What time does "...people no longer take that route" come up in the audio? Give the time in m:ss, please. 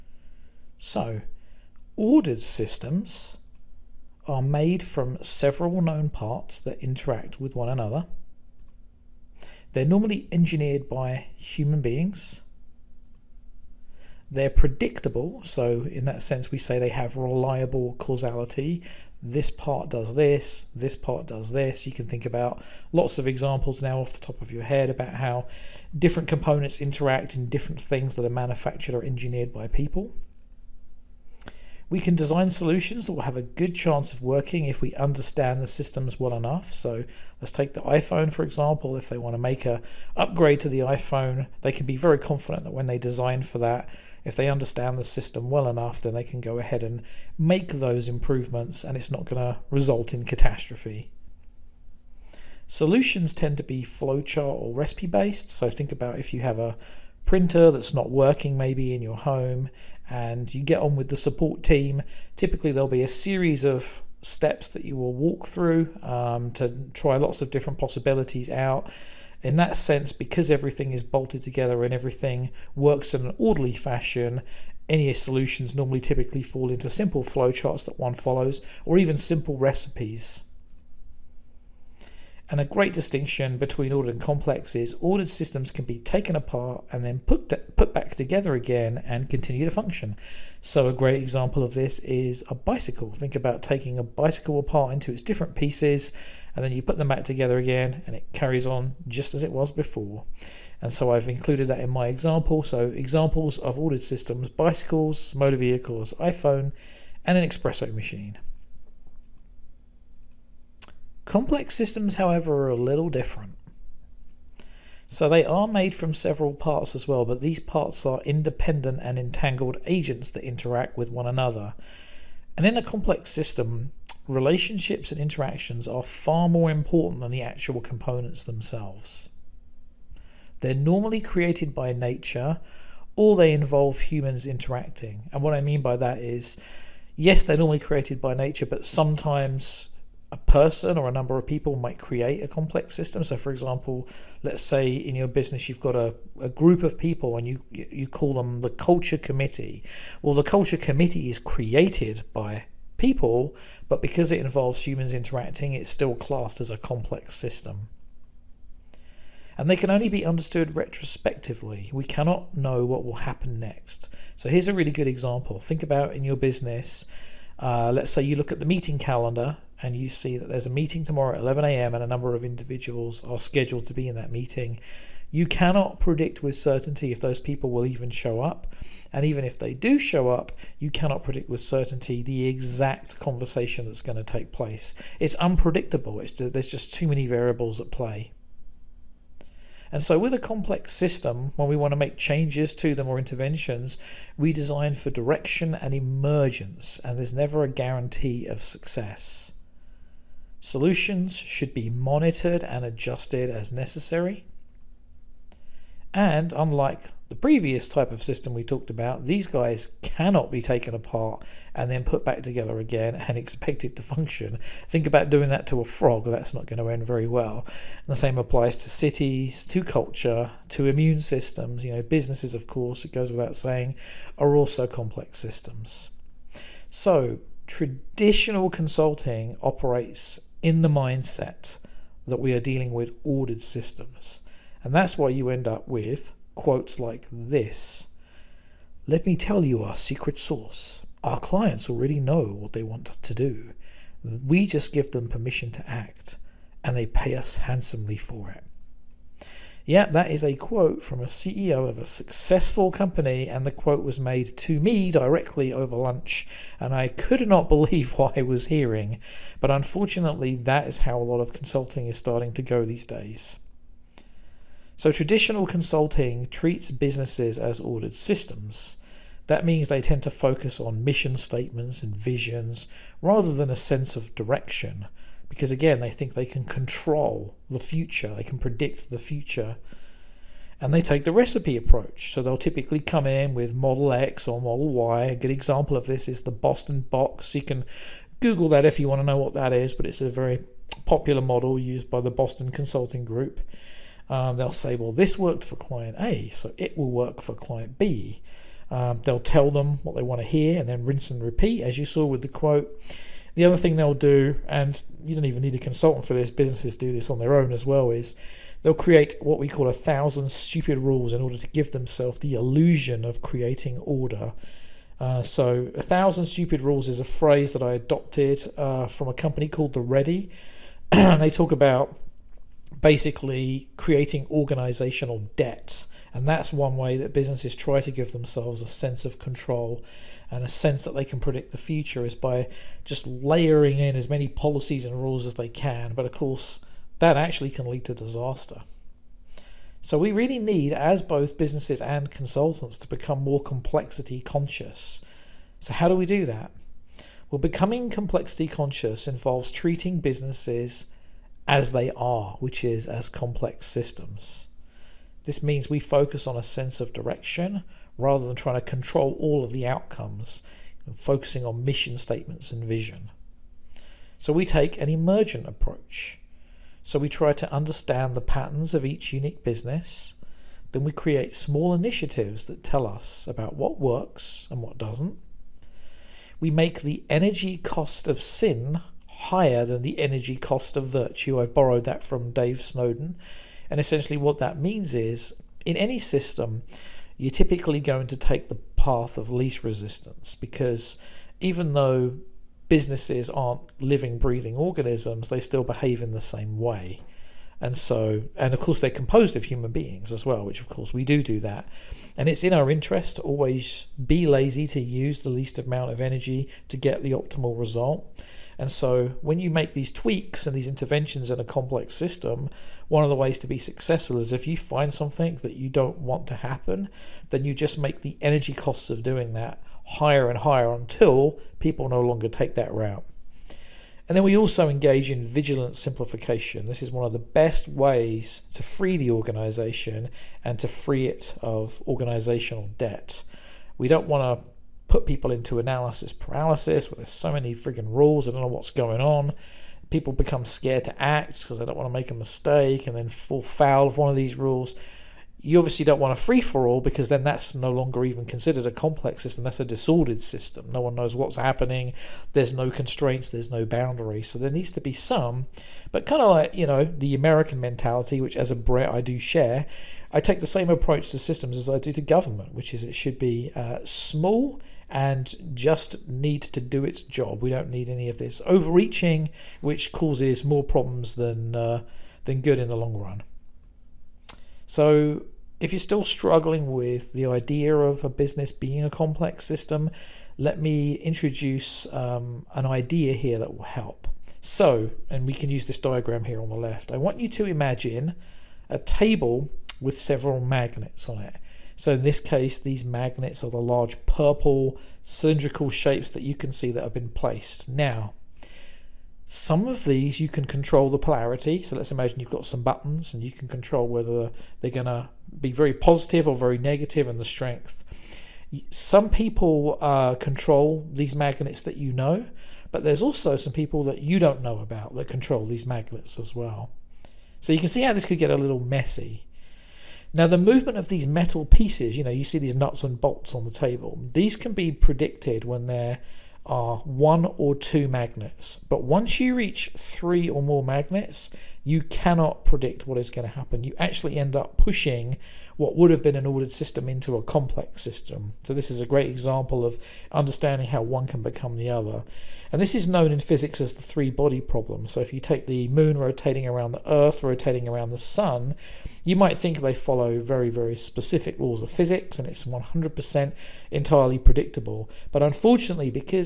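7:01.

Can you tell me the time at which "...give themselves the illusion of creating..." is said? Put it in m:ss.
5:11.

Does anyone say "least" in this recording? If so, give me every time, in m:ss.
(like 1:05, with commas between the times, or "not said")
6:29, 6:45.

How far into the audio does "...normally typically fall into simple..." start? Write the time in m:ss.
1:15.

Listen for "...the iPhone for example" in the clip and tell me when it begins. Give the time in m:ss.
0:37.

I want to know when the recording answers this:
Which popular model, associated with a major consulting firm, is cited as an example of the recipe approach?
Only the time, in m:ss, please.
4:46.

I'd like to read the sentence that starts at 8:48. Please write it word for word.
But once you reach three or more magnets, you cannot predict what is going to happen.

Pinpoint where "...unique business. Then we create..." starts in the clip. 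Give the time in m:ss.
6:09.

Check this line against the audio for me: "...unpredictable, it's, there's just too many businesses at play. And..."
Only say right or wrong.
wrong.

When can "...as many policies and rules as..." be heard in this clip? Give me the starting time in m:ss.
5:34.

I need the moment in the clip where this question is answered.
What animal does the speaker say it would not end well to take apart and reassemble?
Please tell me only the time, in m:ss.
3:35.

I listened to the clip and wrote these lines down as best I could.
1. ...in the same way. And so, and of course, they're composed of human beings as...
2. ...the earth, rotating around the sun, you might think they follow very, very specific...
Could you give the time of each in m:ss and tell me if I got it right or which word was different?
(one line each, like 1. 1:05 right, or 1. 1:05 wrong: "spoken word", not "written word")
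1. 6:36 right
2. 9:06 right.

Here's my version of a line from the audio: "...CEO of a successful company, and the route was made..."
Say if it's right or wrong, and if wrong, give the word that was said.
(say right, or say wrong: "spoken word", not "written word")
wrong: "quote", not "route".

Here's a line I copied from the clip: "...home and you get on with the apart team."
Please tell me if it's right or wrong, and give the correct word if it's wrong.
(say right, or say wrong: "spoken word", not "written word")
wrong: "support", not "apart".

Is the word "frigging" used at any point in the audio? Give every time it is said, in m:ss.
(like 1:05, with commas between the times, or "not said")
7:17.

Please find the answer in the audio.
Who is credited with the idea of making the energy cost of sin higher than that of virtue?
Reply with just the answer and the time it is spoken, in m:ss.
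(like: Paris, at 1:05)
Dave Snowden, at 6:22.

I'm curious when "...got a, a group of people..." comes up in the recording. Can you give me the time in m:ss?
2:25.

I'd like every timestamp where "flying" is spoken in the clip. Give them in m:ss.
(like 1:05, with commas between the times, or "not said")
not said.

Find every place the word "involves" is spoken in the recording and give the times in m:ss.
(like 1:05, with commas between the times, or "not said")
2:13, 2:34, 5:49.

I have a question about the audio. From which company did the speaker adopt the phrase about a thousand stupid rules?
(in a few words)
The Ready.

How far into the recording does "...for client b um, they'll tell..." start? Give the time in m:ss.
4:57.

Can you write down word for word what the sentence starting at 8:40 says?
Now the movement of these metal pieces, you know, you see these nuts and bolts on the table.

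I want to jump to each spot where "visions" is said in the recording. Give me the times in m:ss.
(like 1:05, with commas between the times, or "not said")
4:32, 6:02.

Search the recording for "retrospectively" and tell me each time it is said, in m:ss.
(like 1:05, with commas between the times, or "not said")
2:40.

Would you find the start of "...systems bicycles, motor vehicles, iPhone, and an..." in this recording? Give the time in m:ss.
1:44.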